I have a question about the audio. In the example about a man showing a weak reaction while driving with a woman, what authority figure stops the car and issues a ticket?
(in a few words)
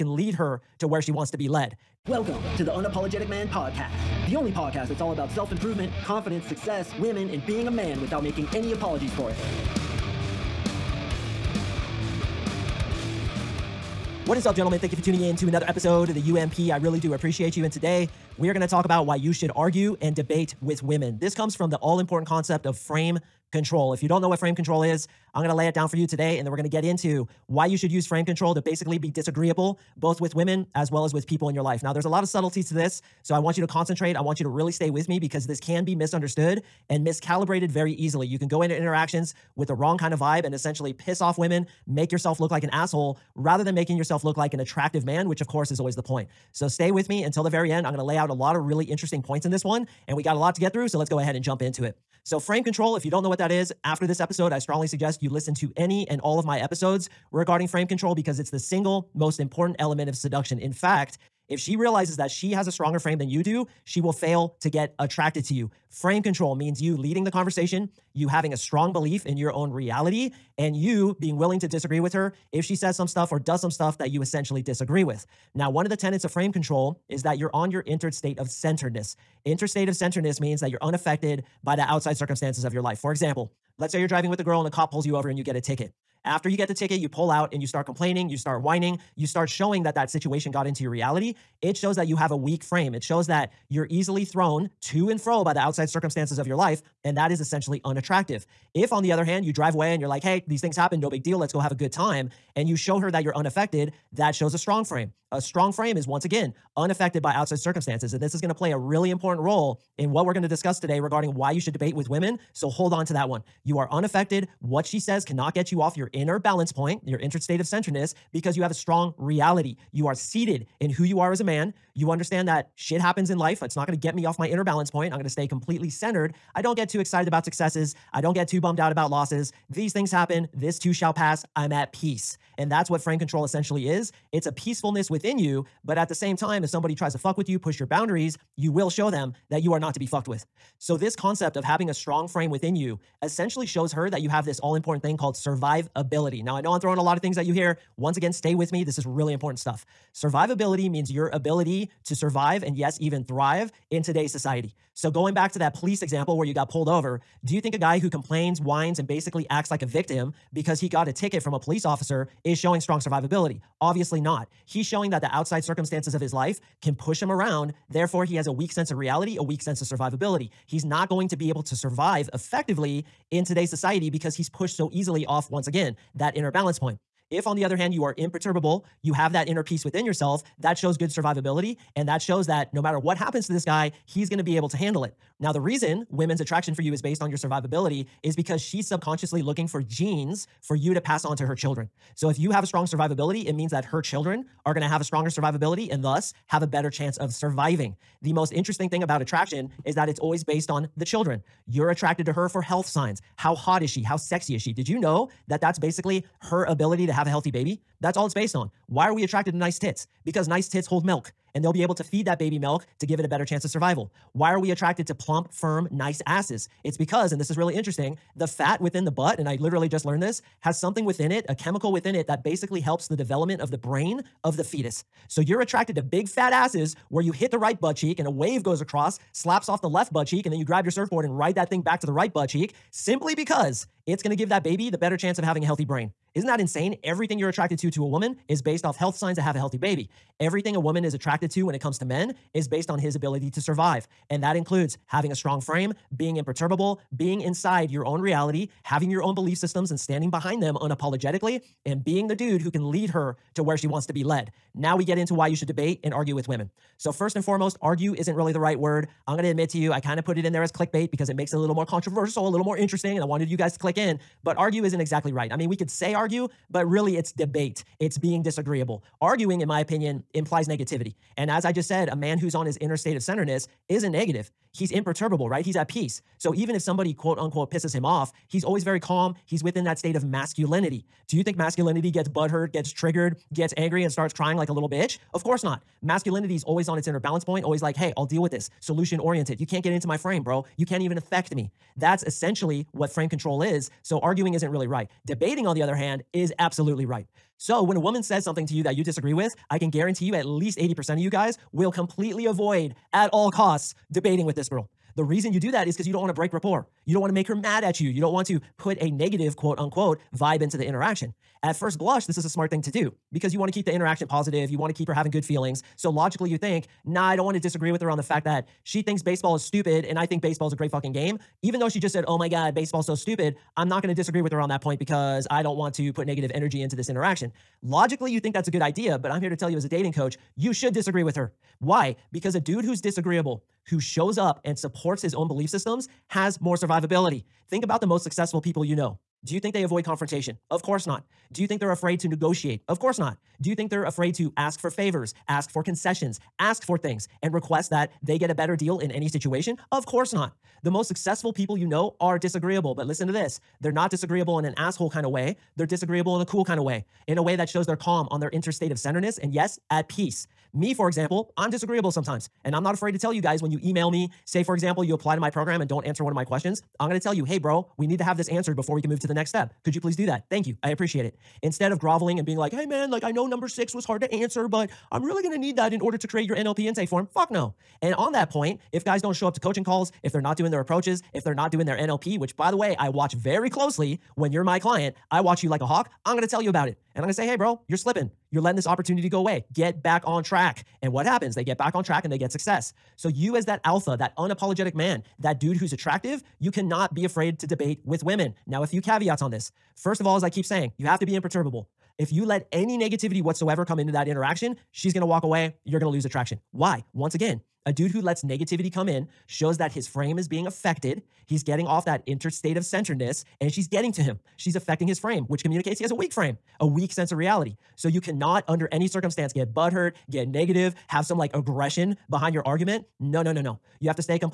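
a cop.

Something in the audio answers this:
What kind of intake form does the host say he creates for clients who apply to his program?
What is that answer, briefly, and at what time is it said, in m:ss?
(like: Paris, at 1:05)
NLP intake form, at 6:16.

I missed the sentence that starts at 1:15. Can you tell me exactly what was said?
Now, one of the tenets of frame control is that you're on your entered state of centeredness.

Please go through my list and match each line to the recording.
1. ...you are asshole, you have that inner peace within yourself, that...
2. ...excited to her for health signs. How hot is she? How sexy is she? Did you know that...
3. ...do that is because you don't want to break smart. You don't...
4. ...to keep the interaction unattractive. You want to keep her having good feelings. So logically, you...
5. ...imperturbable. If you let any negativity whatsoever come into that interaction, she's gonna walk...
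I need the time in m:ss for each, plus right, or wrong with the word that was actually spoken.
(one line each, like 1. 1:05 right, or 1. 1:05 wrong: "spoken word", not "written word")
1. 2:57 wrong: "imperturbable", not "asshole"
2. 3:21 wrong: "attracted", not "excited"
3. 5:05 wrong: "rapport", not "smart"
4. 5:13 wrong: "positive", not "unattractive"
5. 6:41 right.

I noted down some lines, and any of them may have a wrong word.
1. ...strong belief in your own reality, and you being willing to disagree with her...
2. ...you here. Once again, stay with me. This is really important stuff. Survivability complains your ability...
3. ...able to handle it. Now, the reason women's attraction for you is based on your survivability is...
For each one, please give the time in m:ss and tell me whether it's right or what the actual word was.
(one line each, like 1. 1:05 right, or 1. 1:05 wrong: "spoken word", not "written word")
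1. 1:08 right
2. 2:27 wrong: "means", not "complains"
3. 3:04 right.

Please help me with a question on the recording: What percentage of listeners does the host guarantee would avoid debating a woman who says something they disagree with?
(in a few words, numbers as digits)
80%.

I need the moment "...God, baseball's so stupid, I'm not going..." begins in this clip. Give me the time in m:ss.
5:22.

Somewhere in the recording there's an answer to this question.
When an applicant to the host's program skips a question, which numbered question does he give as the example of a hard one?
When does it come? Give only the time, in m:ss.
6:13.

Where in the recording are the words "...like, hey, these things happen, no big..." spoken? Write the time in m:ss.
1:40.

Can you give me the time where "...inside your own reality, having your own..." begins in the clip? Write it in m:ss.
4:07.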